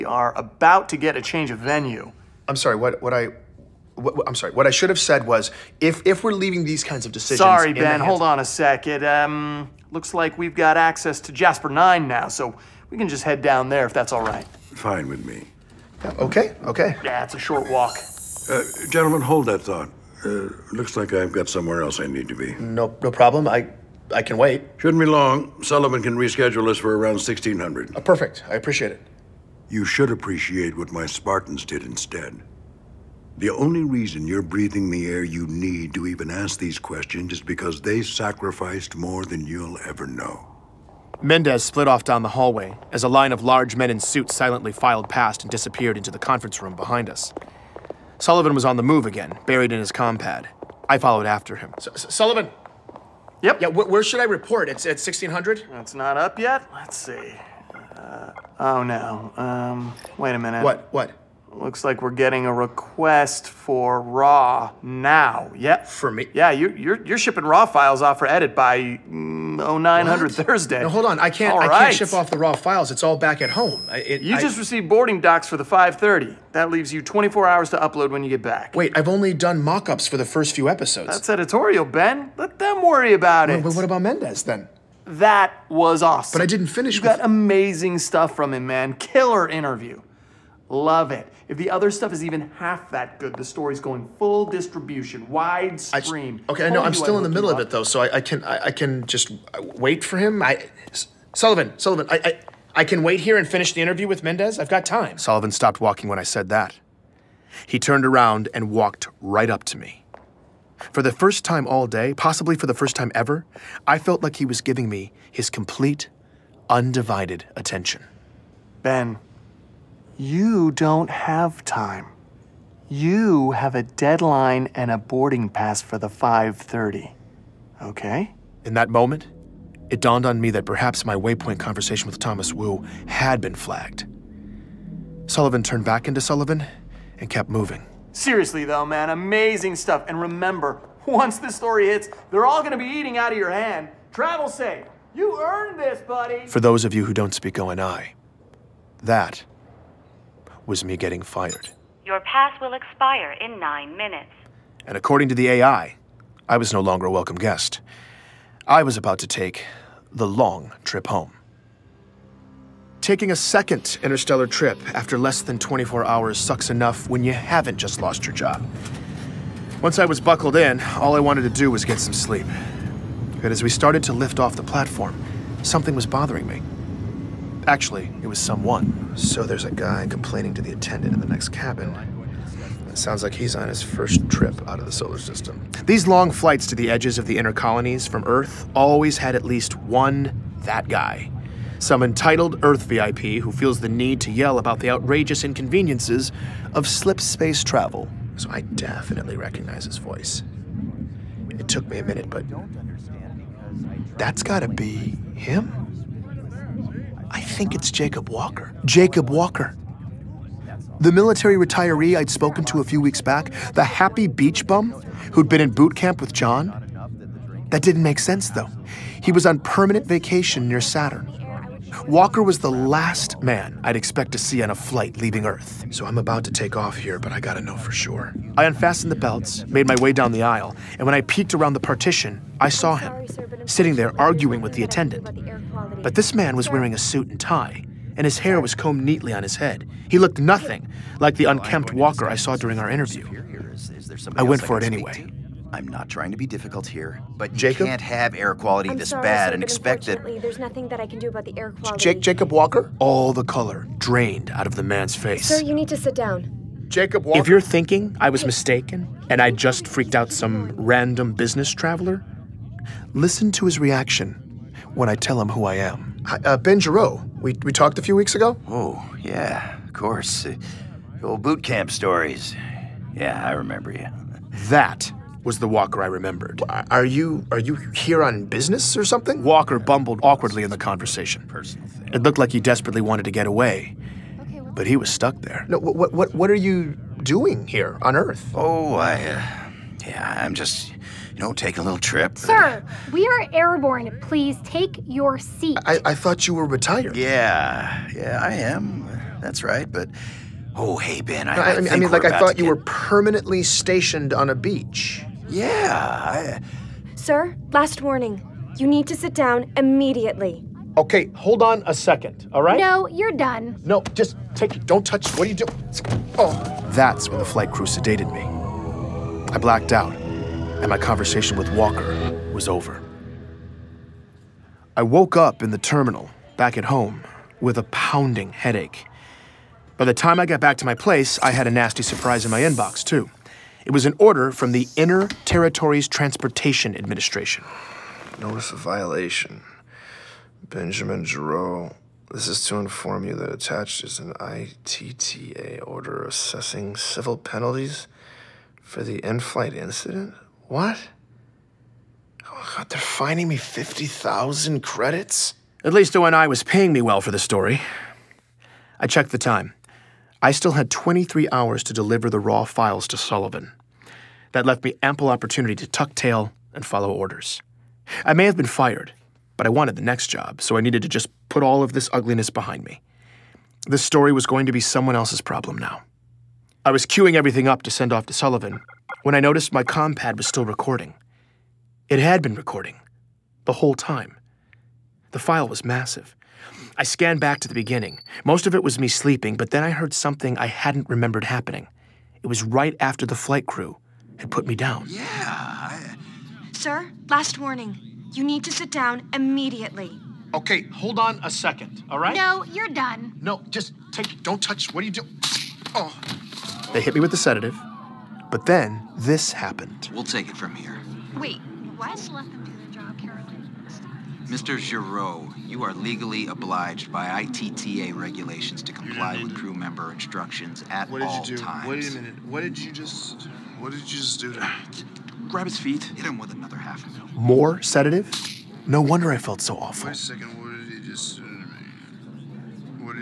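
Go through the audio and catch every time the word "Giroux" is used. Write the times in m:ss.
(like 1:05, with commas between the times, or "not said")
4:26, 5:41, 6:54.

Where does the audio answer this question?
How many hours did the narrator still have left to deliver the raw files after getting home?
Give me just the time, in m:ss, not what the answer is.
6:00.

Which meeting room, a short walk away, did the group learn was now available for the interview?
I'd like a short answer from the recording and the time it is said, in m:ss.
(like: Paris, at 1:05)
Jasper Nine, at 0:11.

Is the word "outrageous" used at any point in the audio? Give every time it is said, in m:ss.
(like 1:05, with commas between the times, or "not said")
3:14.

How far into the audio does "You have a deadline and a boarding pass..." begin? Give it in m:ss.
2:02.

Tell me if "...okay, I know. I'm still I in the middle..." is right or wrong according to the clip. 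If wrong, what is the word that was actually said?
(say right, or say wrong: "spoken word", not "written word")
right.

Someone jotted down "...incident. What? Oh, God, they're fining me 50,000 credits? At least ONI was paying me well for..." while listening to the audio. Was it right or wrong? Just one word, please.
right.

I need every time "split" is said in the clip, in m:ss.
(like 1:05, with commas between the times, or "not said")
0:41.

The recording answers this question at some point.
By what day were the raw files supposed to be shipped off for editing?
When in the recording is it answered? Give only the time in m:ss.
1:10.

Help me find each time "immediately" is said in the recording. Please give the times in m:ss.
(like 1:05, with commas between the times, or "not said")
5:09, 6:39.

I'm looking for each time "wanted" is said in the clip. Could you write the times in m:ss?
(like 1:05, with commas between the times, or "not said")
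2:51, 4:42, 6:09.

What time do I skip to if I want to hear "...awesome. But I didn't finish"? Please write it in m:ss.
1:26.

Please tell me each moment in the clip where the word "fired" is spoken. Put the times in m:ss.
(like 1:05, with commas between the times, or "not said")
2:31, 6:08.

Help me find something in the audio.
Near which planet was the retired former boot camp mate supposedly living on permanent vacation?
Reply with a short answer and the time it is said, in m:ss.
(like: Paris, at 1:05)
Saturn, at 3:40.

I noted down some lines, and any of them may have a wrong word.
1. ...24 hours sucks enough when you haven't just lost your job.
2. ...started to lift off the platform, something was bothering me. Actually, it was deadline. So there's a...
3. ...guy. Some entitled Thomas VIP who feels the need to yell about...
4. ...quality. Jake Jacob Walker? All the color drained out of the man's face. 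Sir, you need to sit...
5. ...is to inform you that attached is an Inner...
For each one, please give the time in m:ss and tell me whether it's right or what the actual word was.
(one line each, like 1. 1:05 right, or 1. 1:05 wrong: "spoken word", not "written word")
1. 2:45 right
2. 2:53 wrong: "someone", not "deadline"
3. 3:10 wrong: "Earth", not "Thomas"
4. 4:11 right
5. 5:42 wrong: "ITTA", not "Inner".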